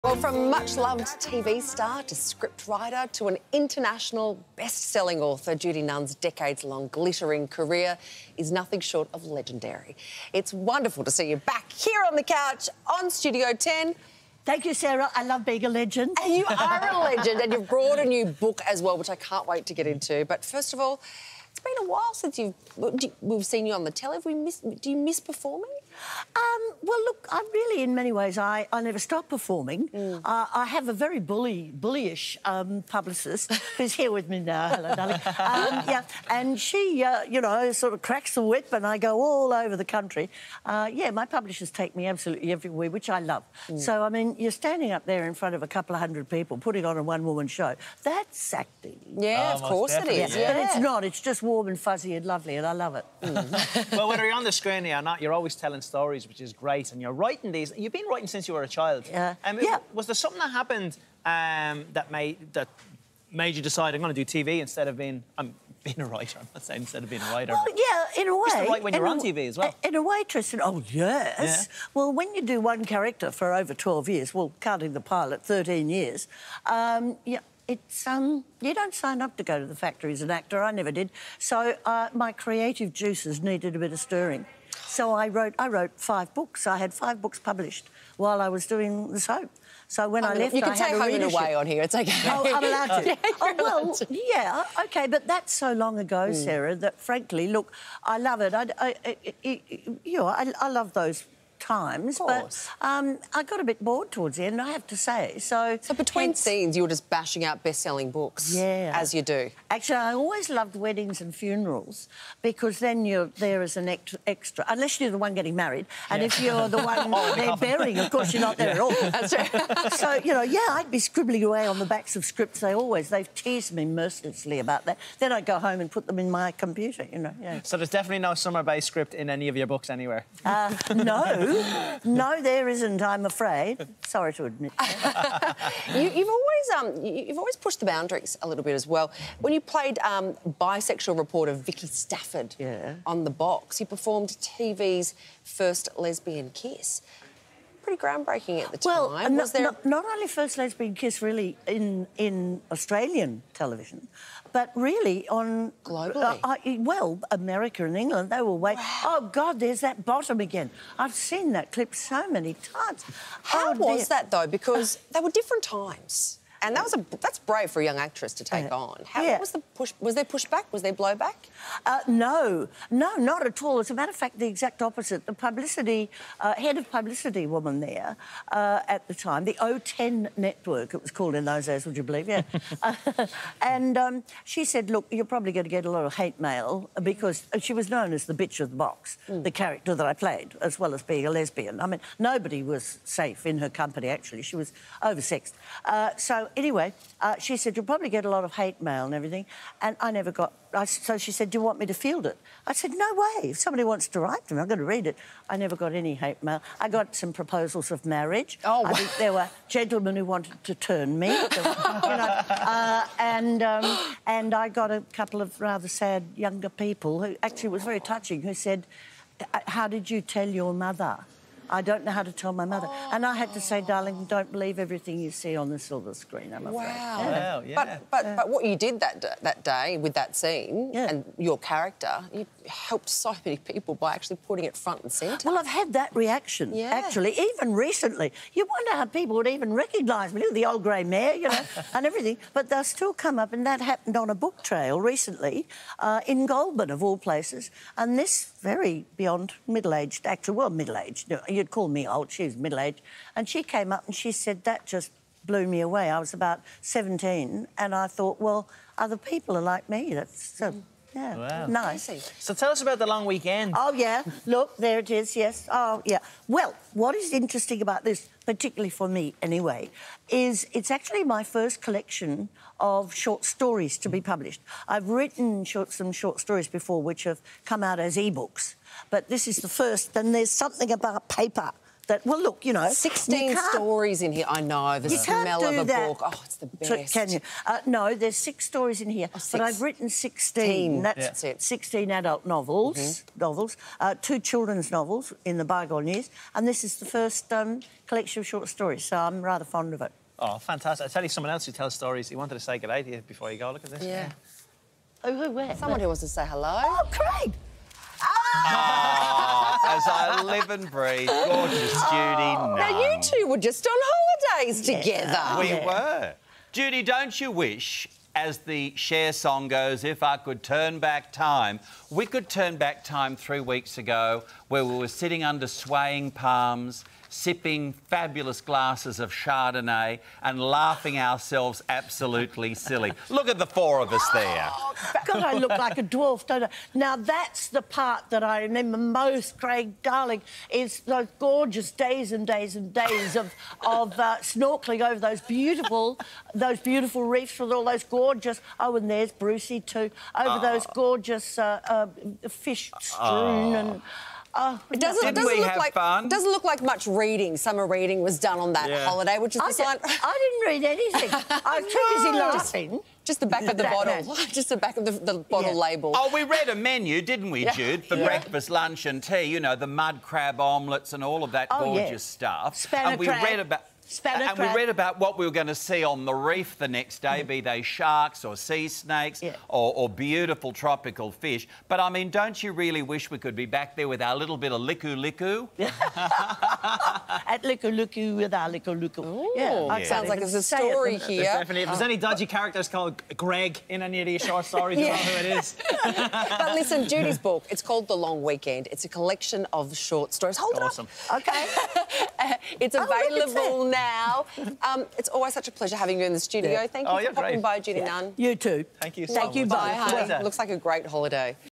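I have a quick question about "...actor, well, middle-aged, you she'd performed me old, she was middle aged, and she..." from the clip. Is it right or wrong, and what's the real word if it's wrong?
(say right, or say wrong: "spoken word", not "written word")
wrong: "called", not "performed".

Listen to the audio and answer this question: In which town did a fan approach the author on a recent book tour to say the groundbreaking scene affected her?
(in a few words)
Goulburn.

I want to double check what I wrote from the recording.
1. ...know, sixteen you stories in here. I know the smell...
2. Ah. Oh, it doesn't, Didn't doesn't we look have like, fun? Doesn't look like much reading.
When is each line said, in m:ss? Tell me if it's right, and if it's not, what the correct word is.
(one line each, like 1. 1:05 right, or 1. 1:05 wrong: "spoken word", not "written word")
1. 4:42 right
2. 5:54 right.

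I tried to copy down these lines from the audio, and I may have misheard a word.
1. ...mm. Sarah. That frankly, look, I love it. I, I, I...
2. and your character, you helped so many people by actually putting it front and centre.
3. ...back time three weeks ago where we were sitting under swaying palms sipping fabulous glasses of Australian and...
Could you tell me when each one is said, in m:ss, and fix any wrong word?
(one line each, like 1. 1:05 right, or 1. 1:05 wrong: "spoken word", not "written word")
1. 1:36 right
2. 3:51 right
3. 5:22 wrong: "Chardonnay", not "Australian".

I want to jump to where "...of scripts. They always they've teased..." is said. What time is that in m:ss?
2:02.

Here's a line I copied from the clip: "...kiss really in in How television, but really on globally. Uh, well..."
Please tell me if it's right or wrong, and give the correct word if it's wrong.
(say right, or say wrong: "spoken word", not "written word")
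wrong: "Australian", not "How".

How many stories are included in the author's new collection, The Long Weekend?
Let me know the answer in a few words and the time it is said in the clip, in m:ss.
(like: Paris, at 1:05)
6, at 4:48.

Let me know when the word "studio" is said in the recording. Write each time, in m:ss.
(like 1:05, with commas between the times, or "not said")
0:13, 6:46.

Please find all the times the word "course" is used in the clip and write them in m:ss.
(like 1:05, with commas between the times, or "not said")
0:49, 1:58.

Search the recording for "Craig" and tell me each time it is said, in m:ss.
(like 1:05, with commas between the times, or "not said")
5:07, 5:39.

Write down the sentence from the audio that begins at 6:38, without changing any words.
It's a collection of short stories.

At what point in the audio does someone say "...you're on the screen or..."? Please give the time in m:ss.
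0:54.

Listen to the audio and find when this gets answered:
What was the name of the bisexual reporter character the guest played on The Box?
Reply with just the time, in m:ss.
2:21.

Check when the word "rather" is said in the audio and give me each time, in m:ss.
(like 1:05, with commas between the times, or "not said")
3:35, 4:59.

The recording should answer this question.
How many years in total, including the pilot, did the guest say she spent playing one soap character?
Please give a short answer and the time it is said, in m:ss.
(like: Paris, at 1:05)
13 years, at 1:15.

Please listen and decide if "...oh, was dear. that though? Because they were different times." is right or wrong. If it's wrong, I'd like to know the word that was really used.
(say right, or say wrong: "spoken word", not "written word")
right.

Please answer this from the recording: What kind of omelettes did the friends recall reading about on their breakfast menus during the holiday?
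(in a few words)
Mud crab.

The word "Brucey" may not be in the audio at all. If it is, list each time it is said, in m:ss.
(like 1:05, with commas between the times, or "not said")
5:49.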